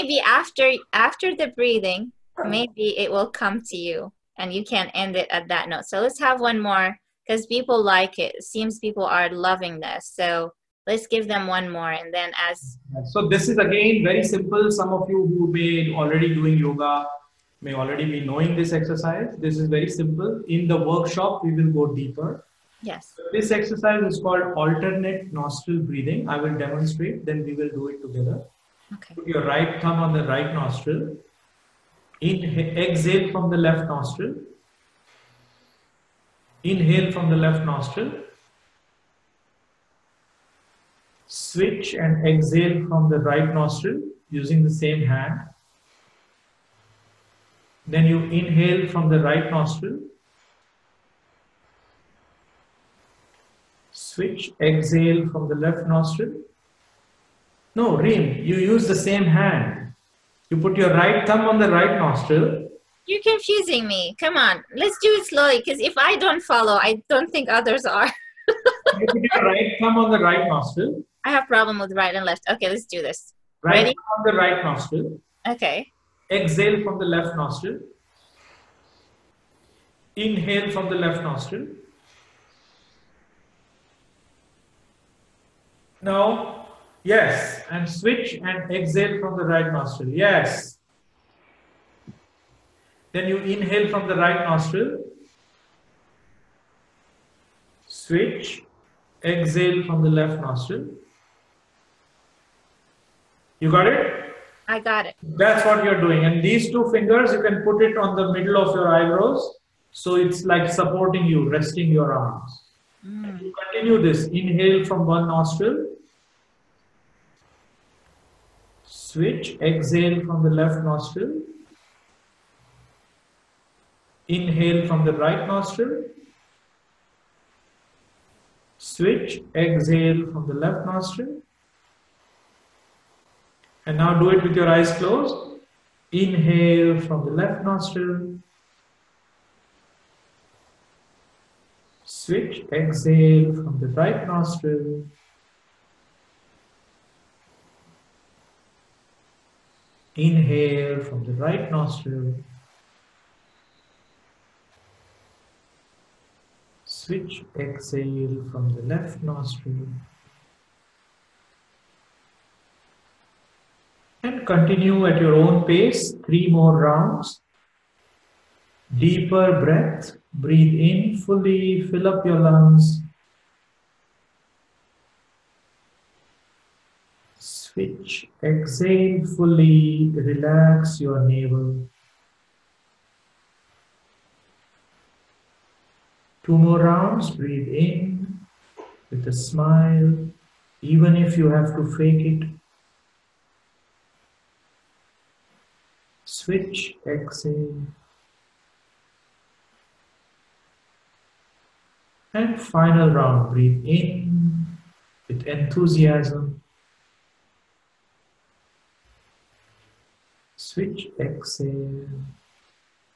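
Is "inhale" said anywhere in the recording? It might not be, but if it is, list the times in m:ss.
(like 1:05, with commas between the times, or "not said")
0:36, 0:48, 1:20, 1:33, 1:54, 2:04, 2:16, 2:30.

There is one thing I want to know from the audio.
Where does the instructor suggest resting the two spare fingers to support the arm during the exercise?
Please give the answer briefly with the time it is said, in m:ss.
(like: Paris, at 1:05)
Middle of your eyebrows, at 1:48.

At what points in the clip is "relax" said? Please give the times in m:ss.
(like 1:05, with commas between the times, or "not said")
3:00.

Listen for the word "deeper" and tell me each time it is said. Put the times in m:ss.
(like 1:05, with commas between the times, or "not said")
0:21, 2:48.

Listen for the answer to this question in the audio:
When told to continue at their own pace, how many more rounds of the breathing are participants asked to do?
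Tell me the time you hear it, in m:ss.
2:46.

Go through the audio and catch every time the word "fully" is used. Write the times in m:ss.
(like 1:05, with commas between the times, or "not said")
2:51, 2:59.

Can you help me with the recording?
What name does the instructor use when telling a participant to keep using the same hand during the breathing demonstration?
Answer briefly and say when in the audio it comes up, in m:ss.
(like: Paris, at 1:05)
Reem, at 0:57.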